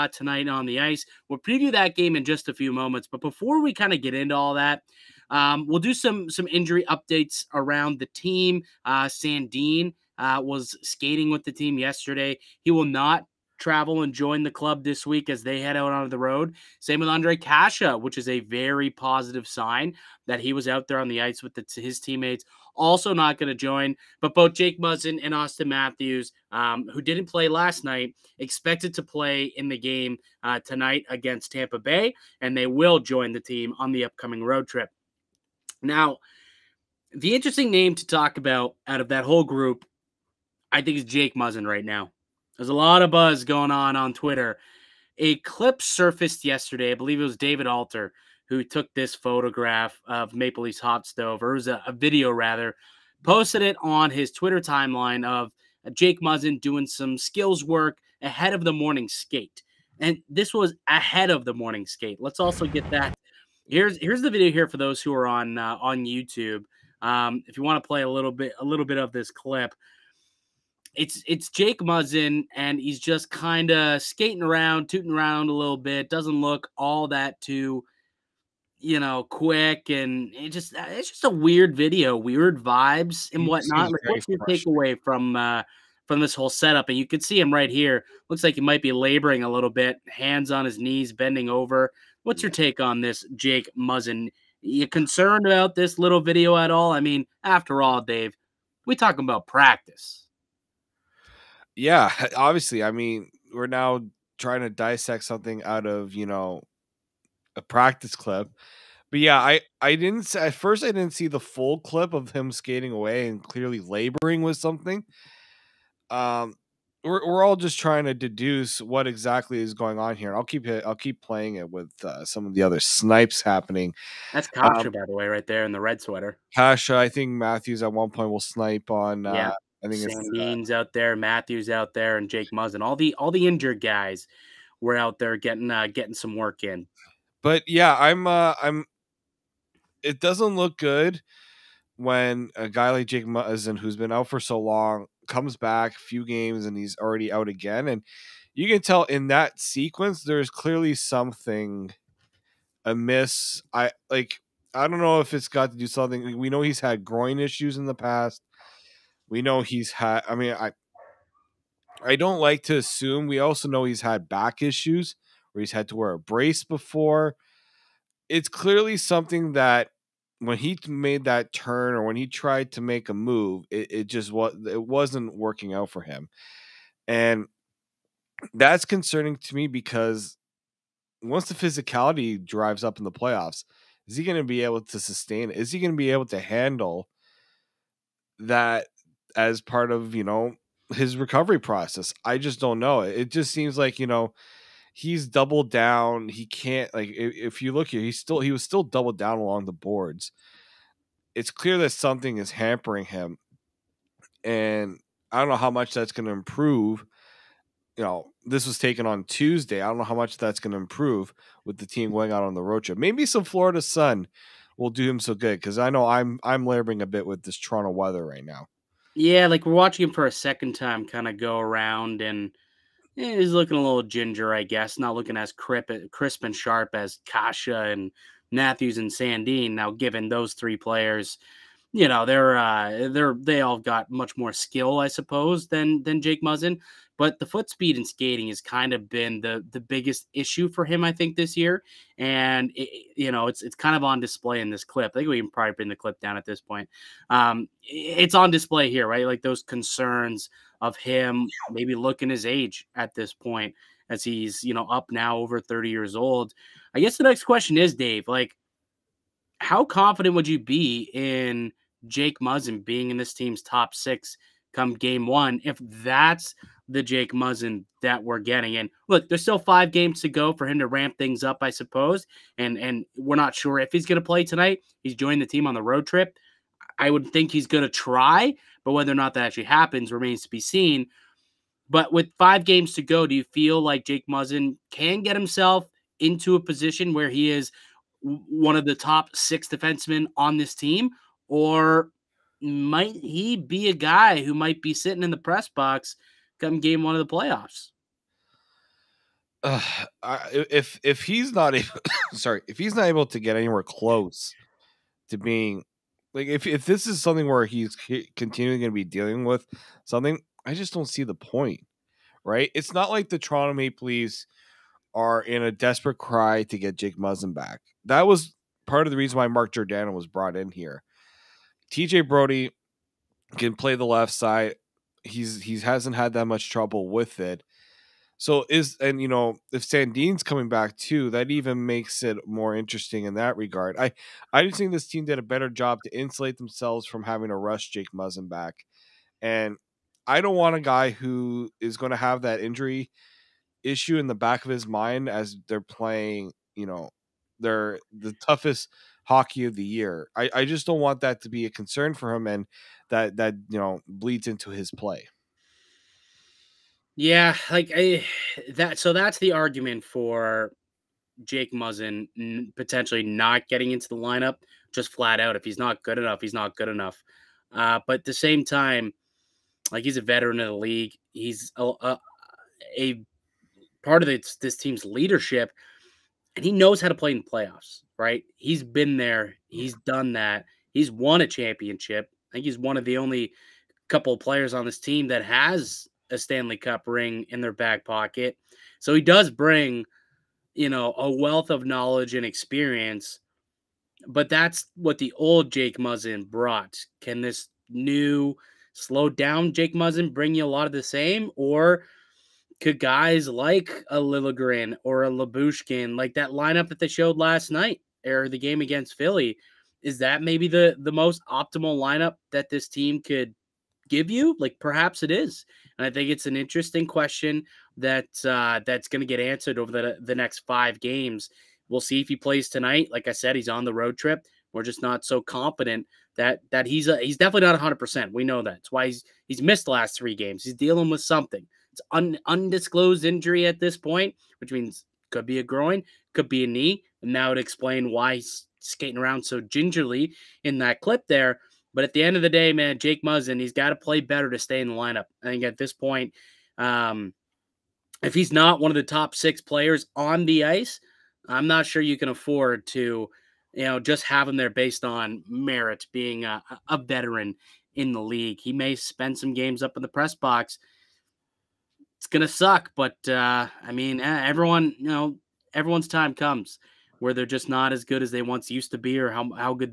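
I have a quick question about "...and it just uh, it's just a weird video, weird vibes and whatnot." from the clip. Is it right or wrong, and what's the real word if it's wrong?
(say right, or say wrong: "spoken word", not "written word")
right.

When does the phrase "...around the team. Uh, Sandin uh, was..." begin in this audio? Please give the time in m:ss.
0:07.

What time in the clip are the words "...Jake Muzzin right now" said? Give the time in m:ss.
0:41.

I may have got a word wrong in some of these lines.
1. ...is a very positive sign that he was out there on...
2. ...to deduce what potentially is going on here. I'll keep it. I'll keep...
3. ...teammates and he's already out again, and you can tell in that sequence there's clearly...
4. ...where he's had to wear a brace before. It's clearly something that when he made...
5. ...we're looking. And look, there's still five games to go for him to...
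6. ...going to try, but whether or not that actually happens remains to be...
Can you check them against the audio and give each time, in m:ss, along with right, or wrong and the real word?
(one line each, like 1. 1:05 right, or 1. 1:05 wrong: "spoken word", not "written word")
1. 0:18 right
2. 1:58 wrong: "exactly", not "potentially"
3. 2:26 wrong: "games", not "teammates"
4. 2:45 right
5. 4:28 wrong: "getting", not "looking"
6. 4:37 right.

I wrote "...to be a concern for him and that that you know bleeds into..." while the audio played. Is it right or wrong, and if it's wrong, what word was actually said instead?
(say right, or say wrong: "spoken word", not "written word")
right.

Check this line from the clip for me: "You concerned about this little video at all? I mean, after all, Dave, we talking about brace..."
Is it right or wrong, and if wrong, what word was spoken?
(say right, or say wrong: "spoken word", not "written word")
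wrong: "practice", not "brace".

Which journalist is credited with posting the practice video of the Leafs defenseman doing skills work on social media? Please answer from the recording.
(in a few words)
David Alter.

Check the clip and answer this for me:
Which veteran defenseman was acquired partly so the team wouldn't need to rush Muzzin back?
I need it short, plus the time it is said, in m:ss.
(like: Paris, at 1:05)
Mark Giordano, at 5:19.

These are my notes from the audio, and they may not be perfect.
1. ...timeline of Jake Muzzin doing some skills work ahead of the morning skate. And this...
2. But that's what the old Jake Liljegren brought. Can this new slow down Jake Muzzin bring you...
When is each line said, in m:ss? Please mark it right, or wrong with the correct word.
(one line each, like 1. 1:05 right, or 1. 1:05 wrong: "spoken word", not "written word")
1. 0:54 right
2. 6:34 wrong: "Muzzin", not "Liljegren".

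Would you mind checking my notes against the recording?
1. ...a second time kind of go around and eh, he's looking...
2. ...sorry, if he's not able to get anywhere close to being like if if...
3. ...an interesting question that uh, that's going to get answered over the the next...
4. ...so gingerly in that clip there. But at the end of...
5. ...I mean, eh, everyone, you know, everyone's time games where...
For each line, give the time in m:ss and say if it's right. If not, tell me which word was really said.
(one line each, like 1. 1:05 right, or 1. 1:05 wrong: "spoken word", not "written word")
1. 3:40 right
2. 5:02 right
3. 6:56 right
4. 7:19 right
5. 7:43 wrong: "comes", not "games".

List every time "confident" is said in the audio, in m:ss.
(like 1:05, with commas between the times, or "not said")
4:19, 7:05.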